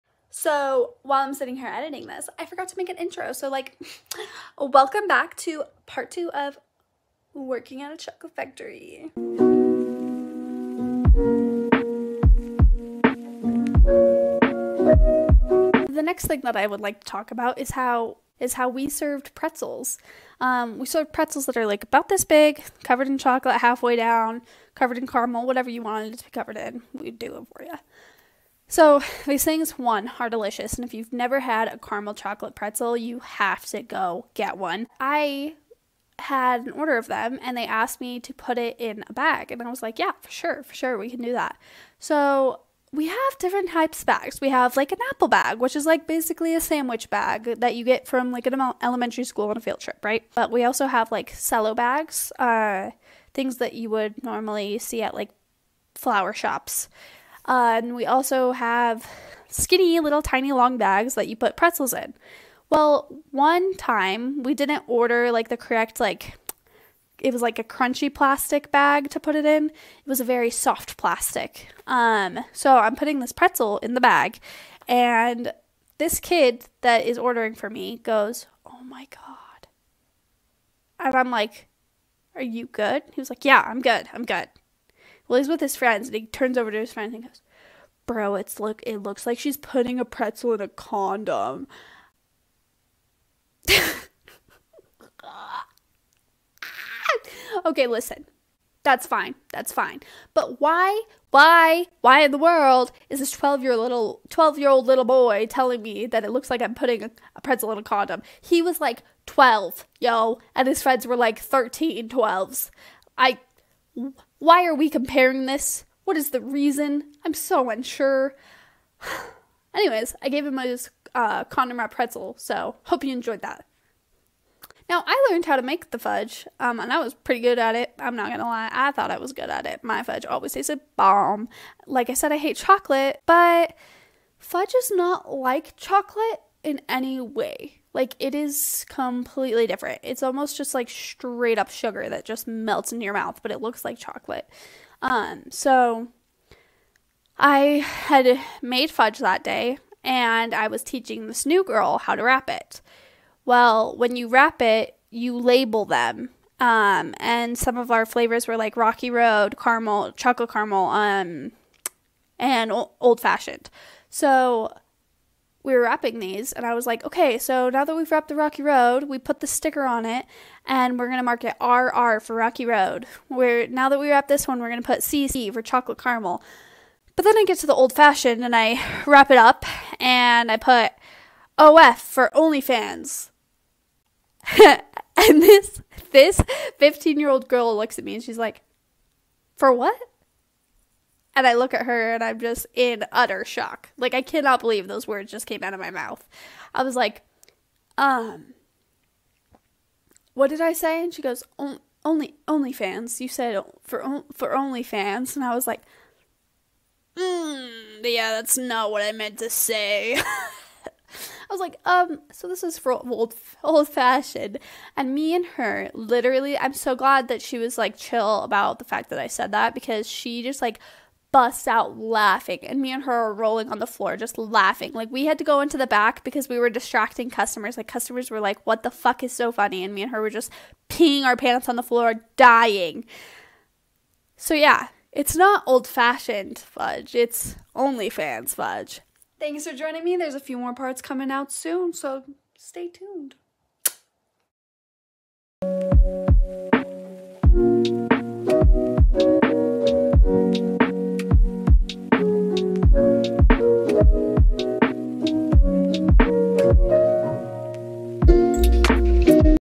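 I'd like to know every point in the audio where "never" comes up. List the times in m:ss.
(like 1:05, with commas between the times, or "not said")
0:31.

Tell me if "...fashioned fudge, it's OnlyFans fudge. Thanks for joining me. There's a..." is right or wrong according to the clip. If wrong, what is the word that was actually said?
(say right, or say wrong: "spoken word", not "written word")
right.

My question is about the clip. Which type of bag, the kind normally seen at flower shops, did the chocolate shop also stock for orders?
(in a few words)
Cello bags.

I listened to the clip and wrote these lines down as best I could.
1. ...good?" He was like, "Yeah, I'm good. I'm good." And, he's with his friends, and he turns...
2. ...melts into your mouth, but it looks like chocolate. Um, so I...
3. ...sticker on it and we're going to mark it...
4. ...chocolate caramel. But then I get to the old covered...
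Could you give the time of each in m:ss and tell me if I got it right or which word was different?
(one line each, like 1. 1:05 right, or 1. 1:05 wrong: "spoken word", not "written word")
1. 1:22 wrong: "Well", not "And"
2. 2:22 right
3. 2:49 right
4. 2:55 wrong: "fashioned", not "covered".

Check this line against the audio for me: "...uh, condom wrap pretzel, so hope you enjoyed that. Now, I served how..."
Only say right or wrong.
wrong.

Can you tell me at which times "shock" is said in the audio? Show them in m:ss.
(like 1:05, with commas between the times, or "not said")
3:13.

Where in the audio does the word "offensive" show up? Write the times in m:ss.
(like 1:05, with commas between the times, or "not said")
not said.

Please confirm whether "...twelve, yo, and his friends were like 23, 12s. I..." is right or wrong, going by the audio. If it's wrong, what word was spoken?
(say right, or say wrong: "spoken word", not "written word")
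wrong: "13", not "23".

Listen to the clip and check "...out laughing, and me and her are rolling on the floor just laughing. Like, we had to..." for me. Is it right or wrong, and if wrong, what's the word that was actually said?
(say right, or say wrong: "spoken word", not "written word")
right.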